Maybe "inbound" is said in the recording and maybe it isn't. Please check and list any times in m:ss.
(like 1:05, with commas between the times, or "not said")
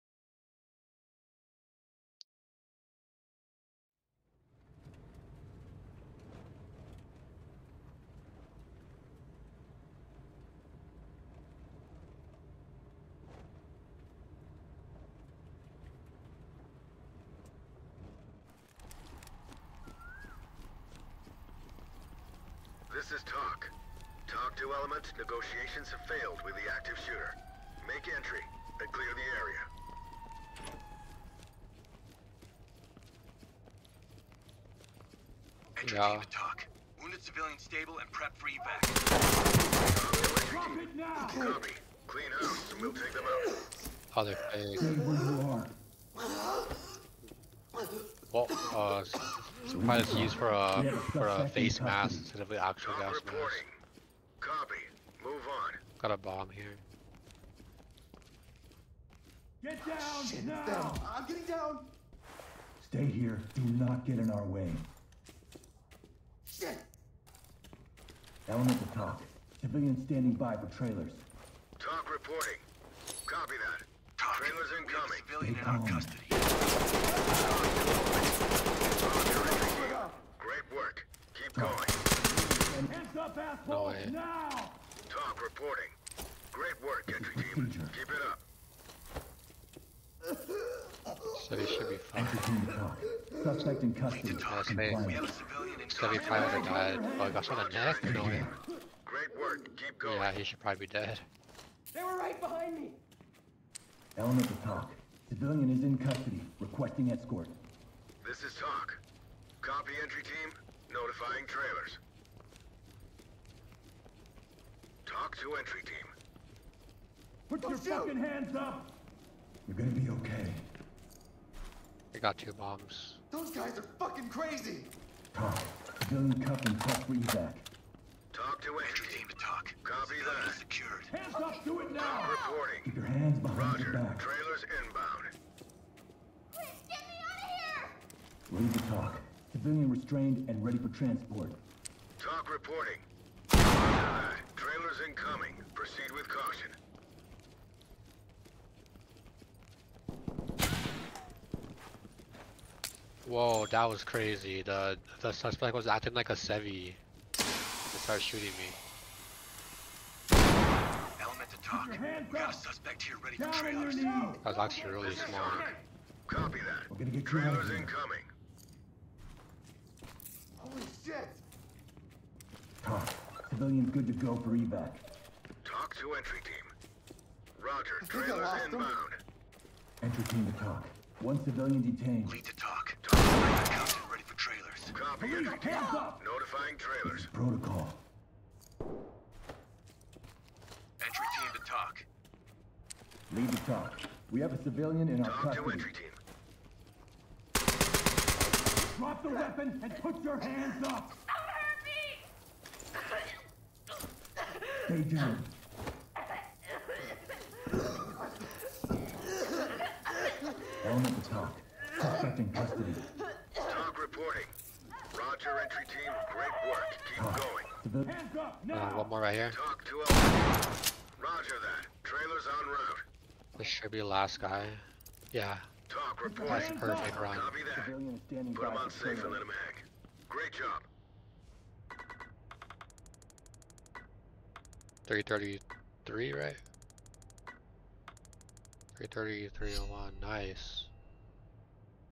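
2:14, 2:58.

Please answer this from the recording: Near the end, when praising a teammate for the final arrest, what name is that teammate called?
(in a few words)
Ron.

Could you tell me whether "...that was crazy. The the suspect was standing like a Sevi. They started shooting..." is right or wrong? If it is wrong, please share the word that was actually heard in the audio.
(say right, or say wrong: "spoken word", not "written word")
wrong: "acting", not "standing".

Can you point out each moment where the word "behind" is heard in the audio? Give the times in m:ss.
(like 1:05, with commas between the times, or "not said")
1:42, 2:13.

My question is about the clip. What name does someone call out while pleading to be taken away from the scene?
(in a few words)
Chris.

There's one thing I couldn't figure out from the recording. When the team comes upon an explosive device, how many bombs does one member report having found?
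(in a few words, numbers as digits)
2.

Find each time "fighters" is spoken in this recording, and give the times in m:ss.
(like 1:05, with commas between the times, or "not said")
not said.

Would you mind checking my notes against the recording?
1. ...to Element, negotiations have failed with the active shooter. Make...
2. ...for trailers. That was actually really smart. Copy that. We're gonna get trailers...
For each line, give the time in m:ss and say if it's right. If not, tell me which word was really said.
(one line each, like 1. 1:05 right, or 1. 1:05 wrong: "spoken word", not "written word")
1. 0:24 right
2. 2:43 right.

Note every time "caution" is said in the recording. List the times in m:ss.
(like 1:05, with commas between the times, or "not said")
2:26.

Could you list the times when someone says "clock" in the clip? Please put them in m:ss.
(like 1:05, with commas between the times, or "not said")
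not said.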